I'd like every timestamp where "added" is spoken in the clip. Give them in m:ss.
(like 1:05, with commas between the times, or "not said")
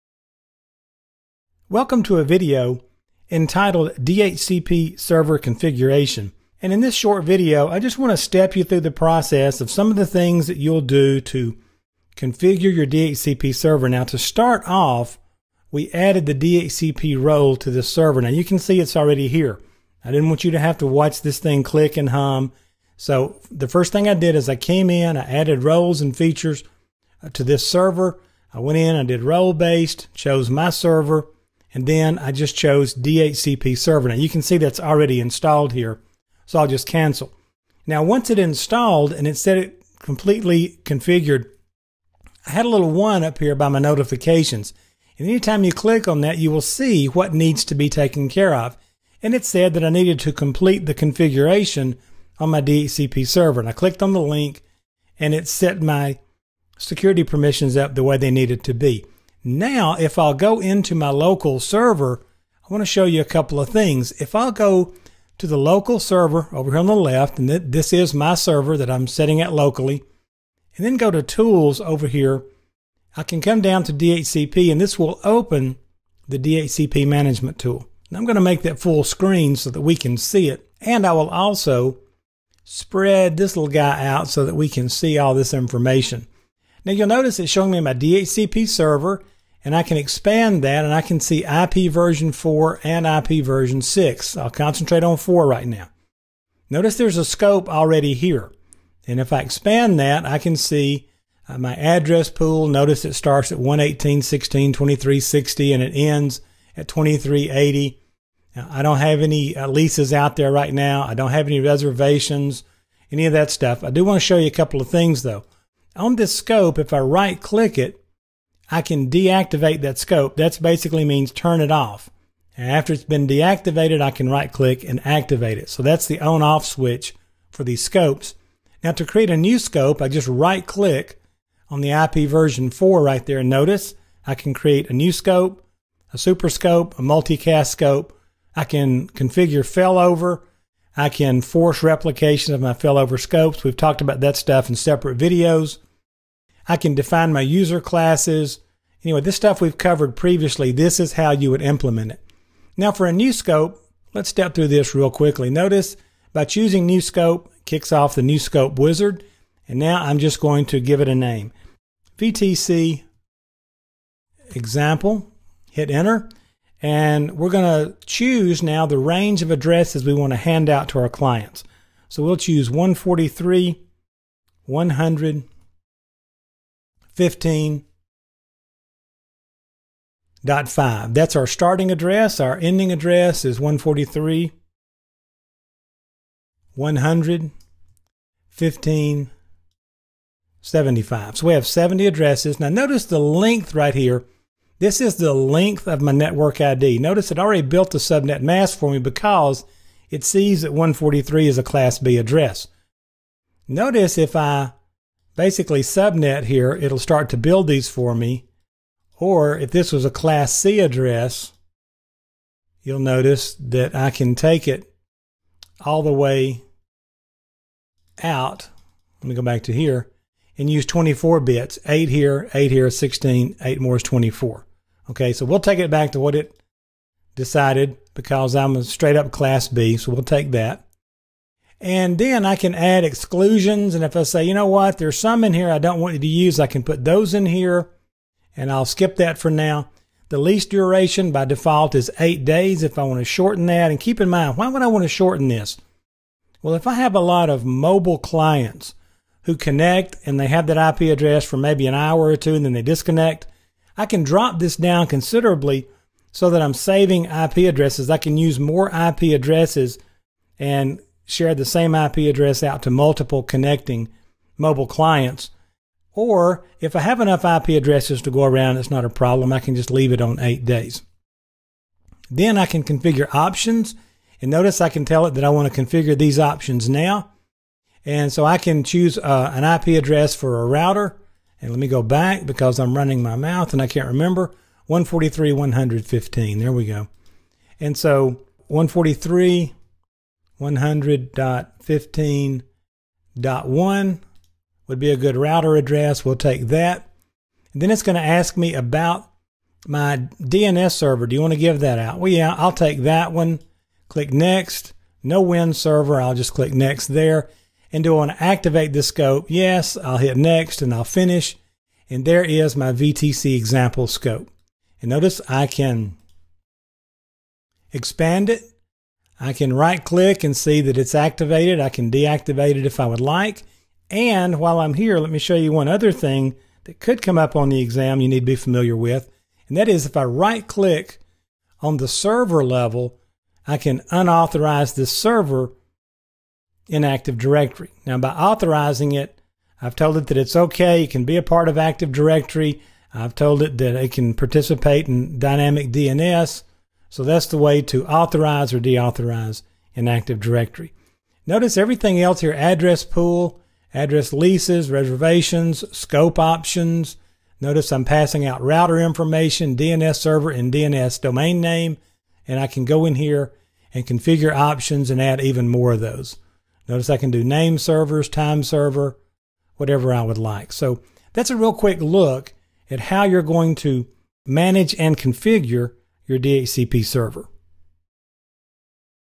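0:15, 0:25.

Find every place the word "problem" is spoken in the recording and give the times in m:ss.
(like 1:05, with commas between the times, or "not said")
4:29.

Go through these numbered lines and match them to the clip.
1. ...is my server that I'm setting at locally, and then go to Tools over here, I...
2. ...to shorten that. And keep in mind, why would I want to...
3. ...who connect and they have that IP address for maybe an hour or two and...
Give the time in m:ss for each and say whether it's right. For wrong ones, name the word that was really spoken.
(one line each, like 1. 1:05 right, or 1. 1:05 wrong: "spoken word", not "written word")
1. 1:07 right
2. 4:03 right
3. 4:09 right.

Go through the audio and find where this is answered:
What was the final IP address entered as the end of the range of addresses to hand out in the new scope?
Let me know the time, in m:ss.
3:03.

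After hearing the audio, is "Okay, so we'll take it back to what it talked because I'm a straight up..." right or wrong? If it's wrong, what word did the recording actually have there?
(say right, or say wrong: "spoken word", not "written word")
wrong: "decided", not "talked".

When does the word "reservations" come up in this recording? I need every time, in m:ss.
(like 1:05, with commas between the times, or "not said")
1:51, 5:54.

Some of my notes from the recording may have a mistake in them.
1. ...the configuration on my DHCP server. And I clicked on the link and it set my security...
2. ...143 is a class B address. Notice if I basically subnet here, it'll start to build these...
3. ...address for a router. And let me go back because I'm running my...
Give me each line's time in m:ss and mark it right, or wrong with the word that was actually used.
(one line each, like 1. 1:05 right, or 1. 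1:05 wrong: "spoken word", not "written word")
1. 0:50 right
2. 3:20 right
3. 4:40 right.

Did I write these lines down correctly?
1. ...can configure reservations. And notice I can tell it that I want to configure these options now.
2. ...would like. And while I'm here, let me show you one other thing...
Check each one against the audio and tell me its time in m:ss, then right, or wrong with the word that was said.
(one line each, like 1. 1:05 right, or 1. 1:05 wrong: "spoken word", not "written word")
1. 4:32 wrong: "options", not "reservations"
2. 5:23 right.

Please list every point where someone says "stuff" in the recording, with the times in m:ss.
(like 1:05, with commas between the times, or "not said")
1:53, 2:24, 2:29.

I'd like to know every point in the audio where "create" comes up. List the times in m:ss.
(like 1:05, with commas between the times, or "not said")
2:09, 2:14.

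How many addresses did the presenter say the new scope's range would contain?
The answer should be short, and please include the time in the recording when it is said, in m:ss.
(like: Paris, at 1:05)
70, at 3:11.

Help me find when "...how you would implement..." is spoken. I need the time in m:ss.
2:31.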